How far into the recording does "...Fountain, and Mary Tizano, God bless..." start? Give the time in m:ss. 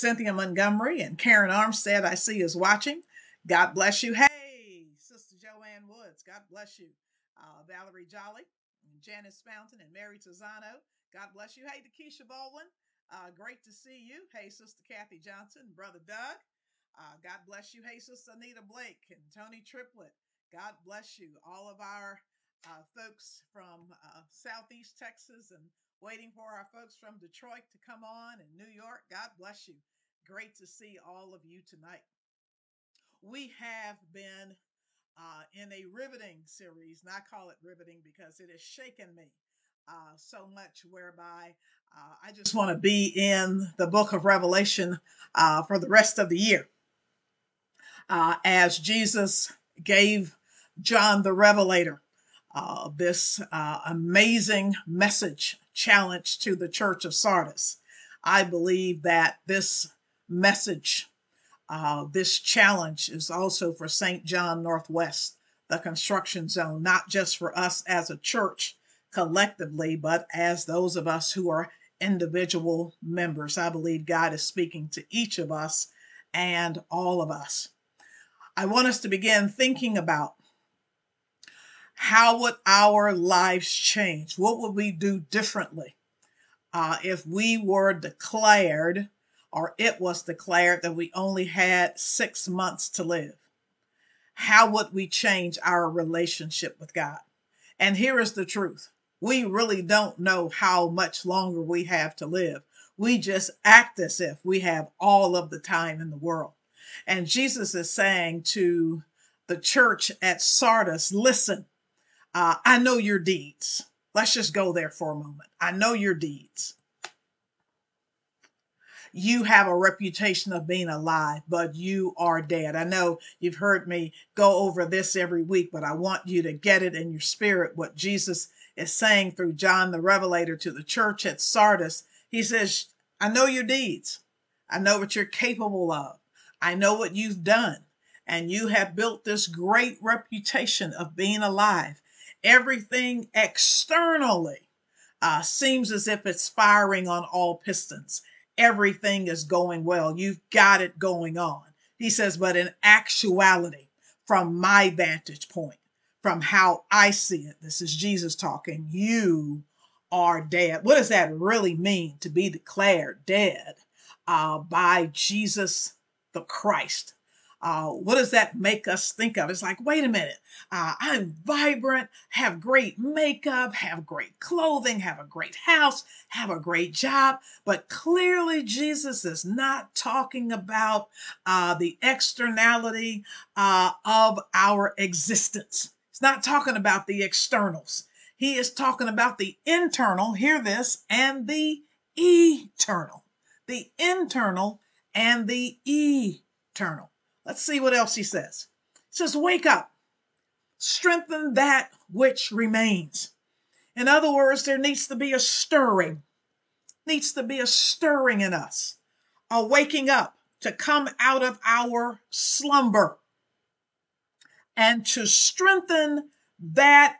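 0:09.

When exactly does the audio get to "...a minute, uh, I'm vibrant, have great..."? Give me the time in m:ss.
2:50.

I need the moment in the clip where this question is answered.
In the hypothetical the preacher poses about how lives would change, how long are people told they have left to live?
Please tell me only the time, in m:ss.
1:31.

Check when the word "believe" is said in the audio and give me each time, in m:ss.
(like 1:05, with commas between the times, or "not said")
0:58, 1:13.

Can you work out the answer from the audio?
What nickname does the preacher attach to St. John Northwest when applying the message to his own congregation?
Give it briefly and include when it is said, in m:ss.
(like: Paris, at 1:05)
the construction zone, at 1:05.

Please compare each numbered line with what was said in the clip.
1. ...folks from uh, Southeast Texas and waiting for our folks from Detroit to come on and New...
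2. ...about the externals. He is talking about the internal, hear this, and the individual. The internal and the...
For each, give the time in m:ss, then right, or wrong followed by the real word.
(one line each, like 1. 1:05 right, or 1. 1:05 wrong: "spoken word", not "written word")
1. 0:22 right
2. 3:06 wrong: "eternal", not "individual".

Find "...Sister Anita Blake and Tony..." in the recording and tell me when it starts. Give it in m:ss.
0:17.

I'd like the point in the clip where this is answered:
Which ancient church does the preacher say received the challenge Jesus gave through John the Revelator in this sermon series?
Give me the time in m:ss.
0:56.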